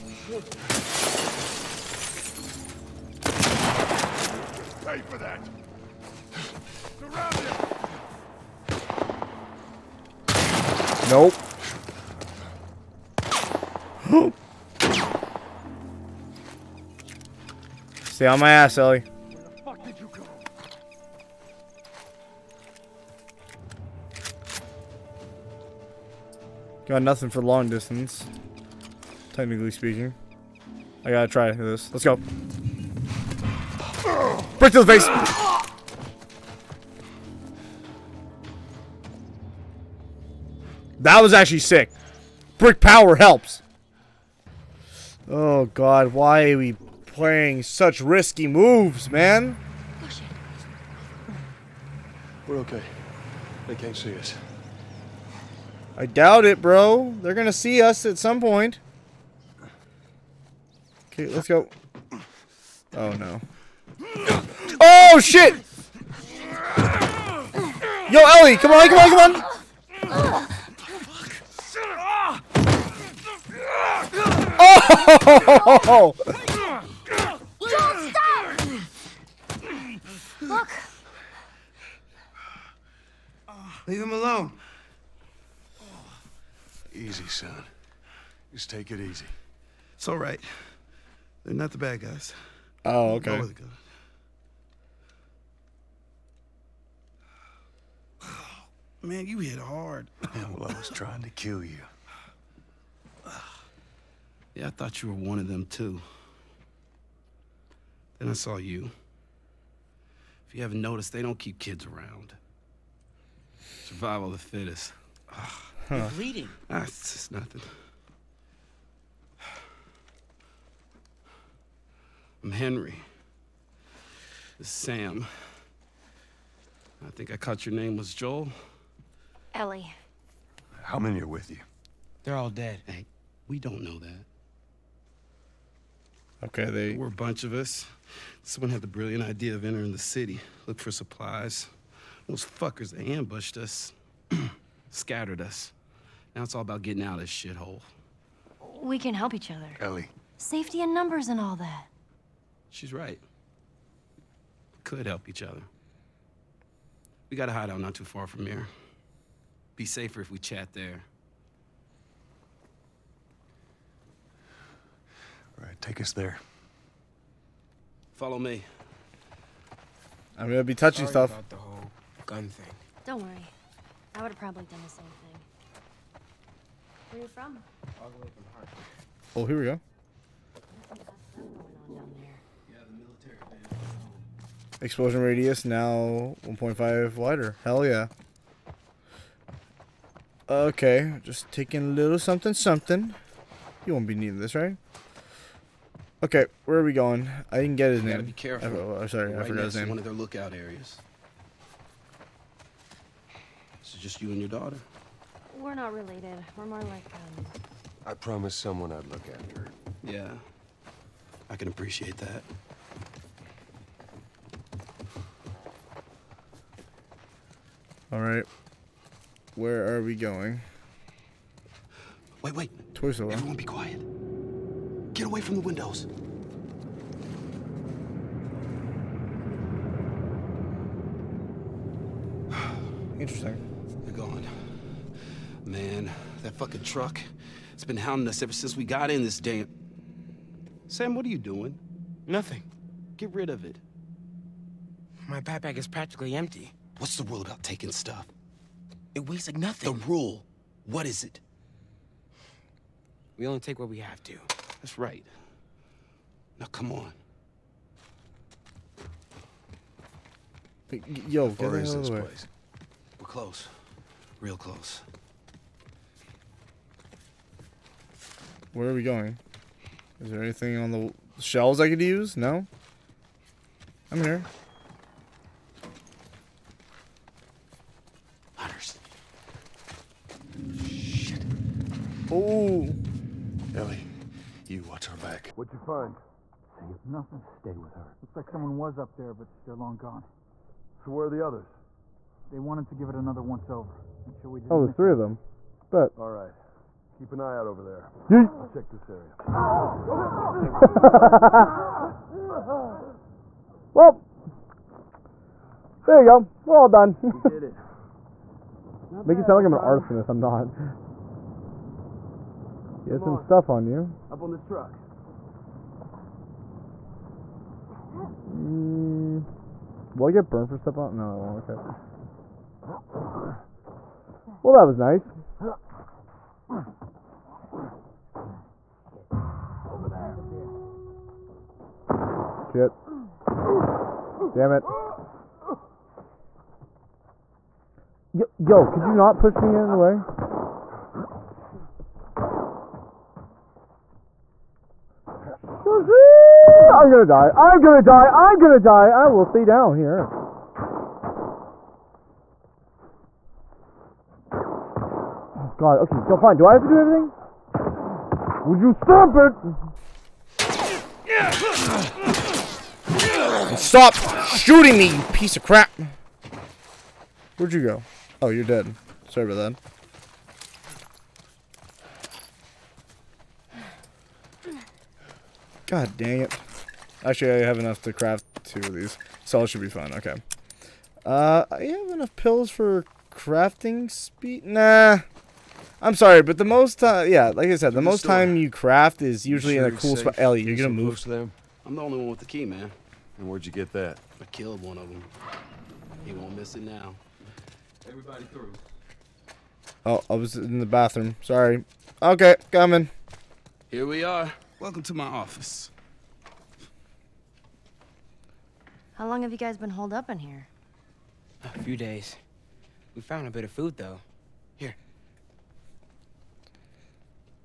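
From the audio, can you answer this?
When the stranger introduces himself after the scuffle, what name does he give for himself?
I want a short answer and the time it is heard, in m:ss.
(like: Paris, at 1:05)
Henry, at 2:02.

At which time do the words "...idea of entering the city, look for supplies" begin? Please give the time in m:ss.
2:19.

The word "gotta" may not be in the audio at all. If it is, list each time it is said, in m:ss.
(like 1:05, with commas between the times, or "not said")
0:31, 3:18.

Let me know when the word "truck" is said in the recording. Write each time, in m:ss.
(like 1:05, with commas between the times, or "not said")
3:56, 5:14.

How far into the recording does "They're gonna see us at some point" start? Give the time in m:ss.
0:57.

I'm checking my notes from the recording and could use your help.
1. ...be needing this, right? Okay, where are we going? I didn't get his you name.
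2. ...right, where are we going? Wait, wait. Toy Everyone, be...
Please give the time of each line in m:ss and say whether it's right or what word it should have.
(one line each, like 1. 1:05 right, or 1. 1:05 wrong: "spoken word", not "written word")
1. 3:14 right
2. 3:38 right.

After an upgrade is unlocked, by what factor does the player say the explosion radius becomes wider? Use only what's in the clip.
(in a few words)
1.5.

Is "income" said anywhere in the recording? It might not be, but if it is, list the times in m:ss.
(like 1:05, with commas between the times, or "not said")
not said.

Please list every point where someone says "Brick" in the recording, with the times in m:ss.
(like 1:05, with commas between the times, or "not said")
0:42.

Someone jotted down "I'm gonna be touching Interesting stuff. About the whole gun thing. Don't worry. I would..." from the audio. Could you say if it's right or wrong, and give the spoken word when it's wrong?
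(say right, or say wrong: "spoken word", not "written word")
wrong: "Sorry", not "Interesting".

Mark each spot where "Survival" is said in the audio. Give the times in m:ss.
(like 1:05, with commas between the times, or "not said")
1:53.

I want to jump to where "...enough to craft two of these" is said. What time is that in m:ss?
6:17.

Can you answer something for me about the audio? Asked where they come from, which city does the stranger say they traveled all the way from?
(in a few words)
Hartford.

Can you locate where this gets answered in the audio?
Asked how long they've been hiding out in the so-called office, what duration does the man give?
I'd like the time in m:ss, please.
6:51.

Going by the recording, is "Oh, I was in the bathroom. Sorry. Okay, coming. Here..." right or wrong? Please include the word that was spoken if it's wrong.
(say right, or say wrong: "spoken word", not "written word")
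right.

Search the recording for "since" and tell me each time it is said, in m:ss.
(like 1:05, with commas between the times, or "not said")
3:58.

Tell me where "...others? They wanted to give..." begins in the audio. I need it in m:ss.
4:51.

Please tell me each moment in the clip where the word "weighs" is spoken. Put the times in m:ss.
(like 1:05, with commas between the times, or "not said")
4:09.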